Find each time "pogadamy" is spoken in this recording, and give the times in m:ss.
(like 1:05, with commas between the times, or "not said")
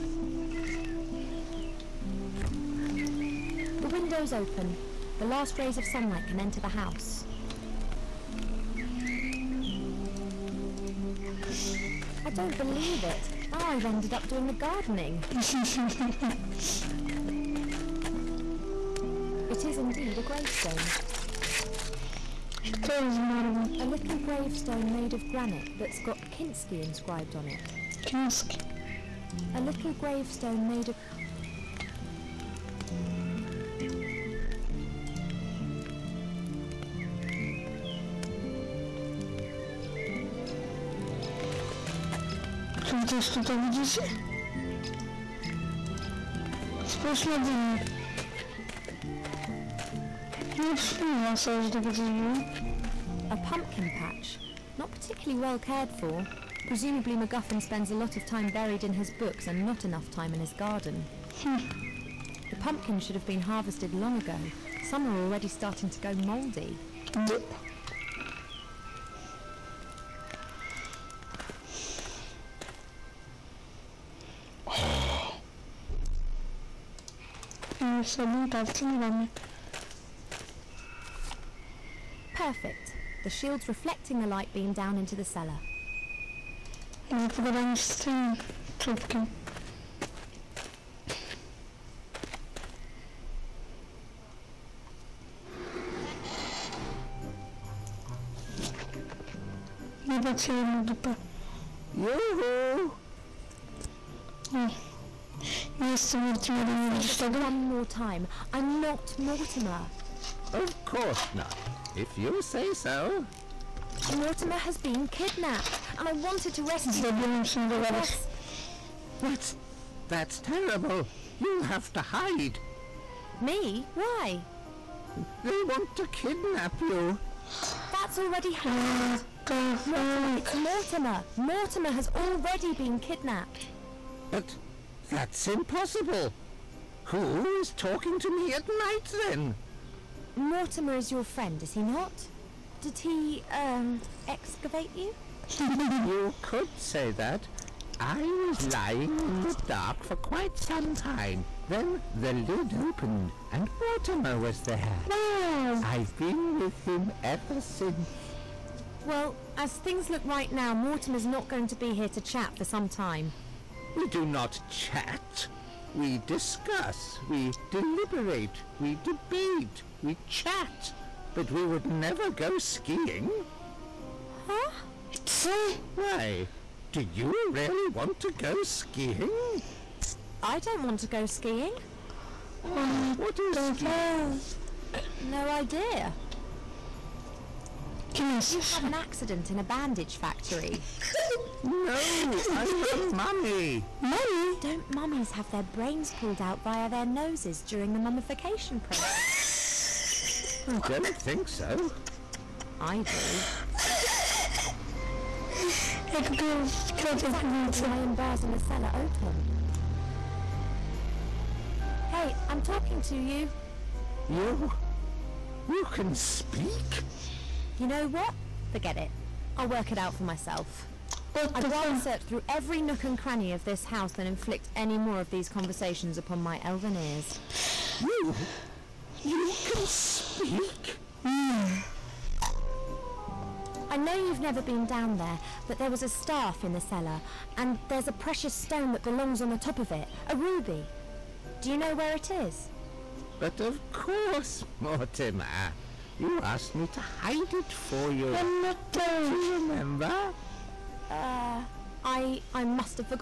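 1:27.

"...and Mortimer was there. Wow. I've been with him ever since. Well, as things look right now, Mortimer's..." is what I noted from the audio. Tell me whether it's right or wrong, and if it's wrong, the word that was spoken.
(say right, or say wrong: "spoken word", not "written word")
right.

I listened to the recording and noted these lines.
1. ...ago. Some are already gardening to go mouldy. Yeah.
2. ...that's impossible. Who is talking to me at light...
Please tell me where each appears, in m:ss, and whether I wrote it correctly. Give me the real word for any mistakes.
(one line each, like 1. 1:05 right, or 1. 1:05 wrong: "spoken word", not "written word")
1. 1:04 wrong: "starting", not "gardening"
2. 2:15 wrong: "night", not "light".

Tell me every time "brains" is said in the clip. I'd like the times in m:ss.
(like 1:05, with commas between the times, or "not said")
3:15.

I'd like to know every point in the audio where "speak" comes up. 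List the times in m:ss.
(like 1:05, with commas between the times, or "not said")
3:36, 3:49.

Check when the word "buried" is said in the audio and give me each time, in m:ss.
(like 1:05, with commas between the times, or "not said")
0:58.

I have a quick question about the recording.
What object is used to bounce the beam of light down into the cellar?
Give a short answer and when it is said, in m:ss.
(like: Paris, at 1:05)
The shield, at 1:23.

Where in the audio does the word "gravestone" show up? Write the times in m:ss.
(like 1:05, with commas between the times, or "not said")
0:20, 0:24, 0:29.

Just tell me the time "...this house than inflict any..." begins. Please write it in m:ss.
3:43.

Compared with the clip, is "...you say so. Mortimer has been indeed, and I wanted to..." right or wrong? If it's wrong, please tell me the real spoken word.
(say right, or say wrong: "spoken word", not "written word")
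wrong: "kidnapped", not "indeed".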